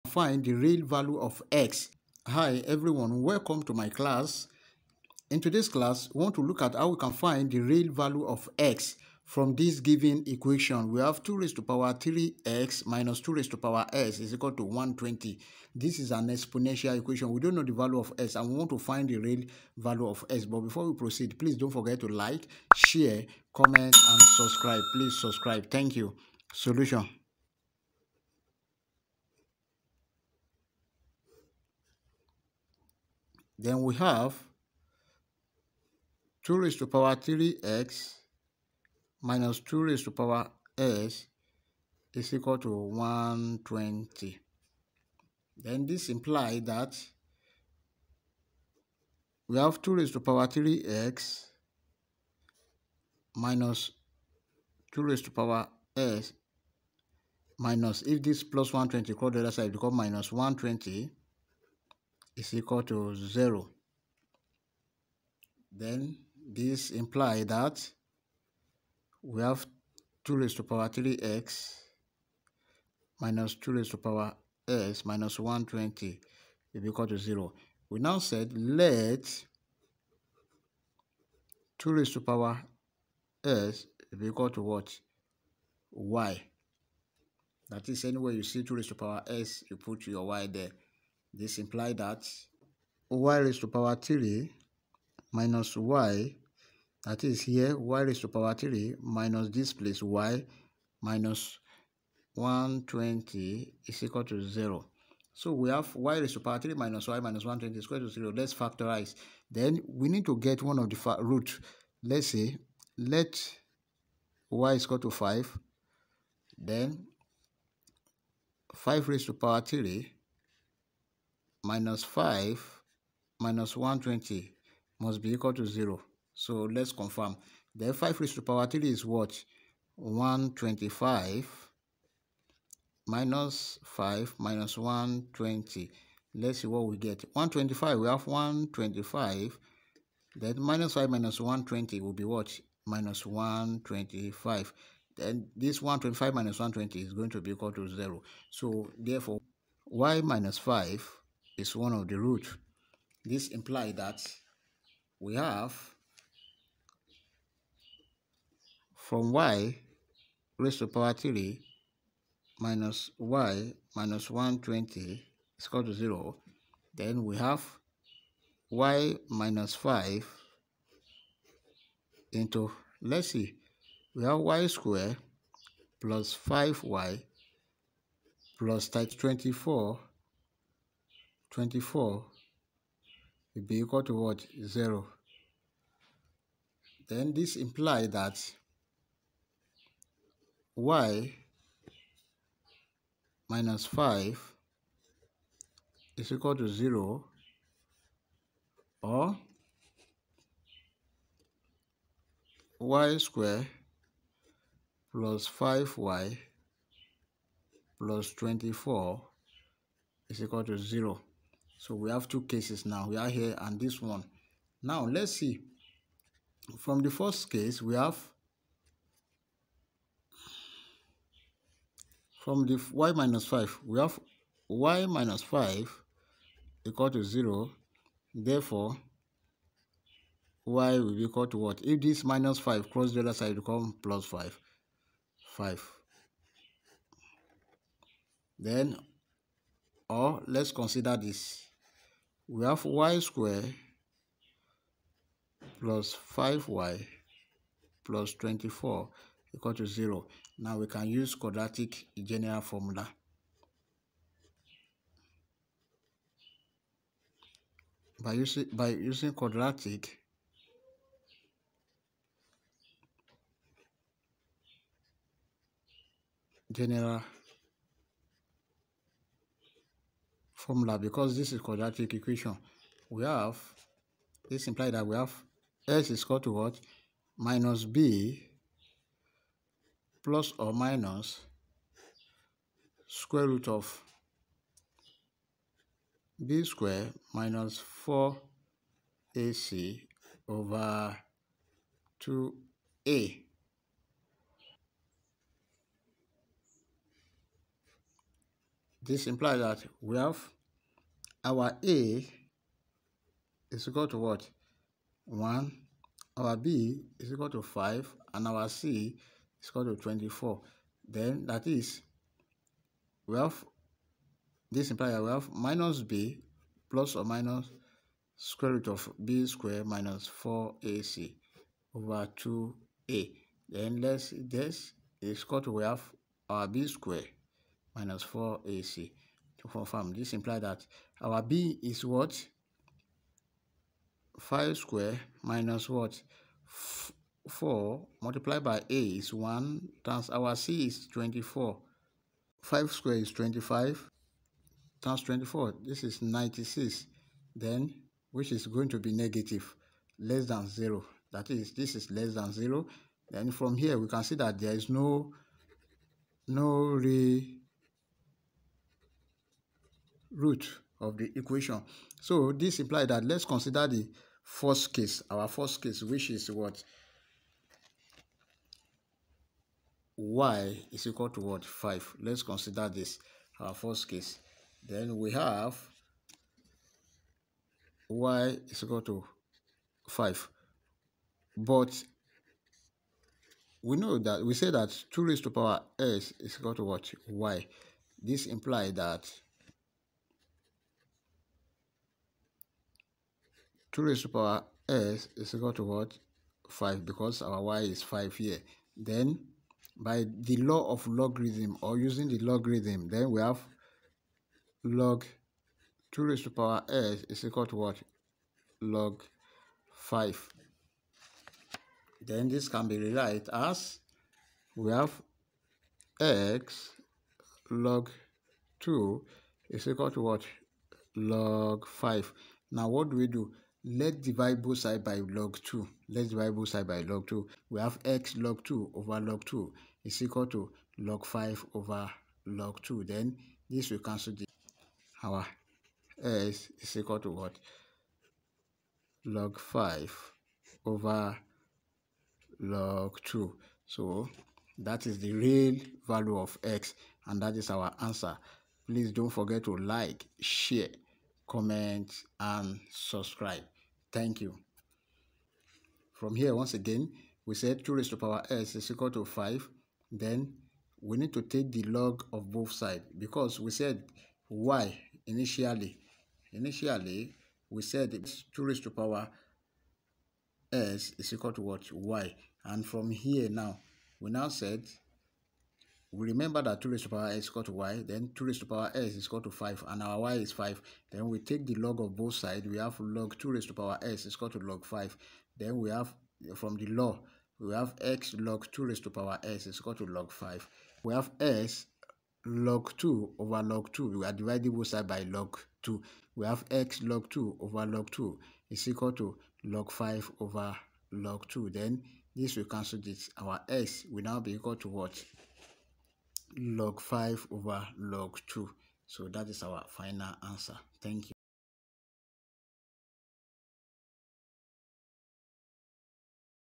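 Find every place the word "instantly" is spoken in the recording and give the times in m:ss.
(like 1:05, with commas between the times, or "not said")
not said.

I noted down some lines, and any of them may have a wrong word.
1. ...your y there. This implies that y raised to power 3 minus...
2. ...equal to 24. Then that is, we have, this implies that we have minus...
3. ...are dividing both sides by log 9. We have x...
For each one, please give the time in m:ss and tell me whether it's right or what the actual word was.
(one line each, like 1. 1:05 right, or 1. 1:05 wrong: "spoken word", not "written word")
1. 1:30 right
2. 5:09 right
3. 8:14 wrong: "2", not "9".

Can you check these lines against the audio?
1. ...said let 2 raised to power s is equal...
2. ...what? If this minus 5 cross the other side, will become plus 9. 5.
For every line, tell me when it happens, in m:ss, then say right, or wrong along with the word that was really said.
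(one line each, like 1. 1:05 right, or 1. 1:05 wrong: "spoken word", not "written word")
1. 1:18 right
2. 3:51 wrong: "5", not "9".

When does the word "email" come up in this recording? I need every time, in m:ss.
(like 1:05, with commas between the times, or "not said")
not said.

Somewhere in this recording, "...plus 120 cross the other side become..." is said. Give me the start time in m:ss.
0:58.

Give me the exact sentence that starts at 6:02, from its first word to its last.
So this implies that let's consider the first case, our first case, which is what?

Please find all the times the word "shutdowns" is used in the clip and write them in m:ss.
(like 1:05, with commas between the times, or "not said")
not said.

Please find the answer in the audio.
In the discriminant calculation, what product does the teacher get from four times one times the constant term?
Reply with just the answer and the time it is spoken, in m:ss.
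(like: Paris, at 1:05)
96, at 5:46.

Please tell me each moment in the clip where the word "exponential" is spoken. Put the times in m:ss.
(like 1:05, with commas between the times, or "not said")
0:16.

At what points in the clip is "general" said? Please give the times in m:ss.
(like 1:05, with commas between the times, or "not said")
4:12, 4:26.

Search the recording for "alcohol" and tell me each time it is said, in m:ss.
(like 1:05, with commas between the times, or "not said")
not said.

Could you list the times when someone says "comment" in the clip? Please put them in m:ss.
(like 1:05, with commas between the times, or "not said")
0:23, 7:31.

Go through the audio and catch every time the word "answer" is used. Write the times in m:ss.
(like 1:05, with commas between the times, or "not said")
7:28, 8:30.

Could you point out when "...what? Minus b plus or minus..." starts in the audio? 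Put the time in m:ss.
4:36.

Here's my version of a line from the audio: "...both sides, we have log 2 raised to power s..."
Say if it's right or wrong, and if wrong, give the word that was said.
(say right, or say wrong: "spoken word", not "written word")
right.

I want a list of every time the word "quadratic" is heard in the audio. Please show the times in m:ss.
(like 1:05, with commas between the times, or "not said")
4:11, 4:19, 4:31.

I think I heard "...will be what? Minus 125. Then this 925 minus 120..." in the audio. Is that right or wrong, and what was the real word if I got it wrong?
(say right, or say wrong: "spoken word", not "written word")
wrong: "125", not "925".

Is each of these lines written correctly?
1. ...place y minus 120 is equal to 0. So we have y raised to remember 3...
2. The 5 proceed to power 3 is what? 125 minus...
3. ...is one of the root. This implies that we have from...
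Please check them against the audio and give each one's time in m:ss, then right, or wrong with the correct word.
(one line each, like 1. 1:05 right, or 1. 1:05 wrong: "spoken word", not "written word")
1. 1:39 wrong: "power", not "remember"
2. 2:07 wrong: "raised", not "proceed"
3. 2:31 right.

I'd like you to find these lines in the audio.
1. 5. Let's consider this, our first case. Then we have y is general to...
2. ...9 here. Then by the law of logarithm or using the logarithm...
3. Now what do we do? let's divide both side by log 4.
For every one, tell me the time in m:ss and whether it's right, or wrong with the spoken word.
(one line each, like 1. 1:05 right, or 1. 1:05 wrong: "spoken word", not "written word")
1. 6:11 wrong: "equal", not "general"
2. 6:38 wrong: "5", not "9"
3. 7:02 wrong: "2", not "4".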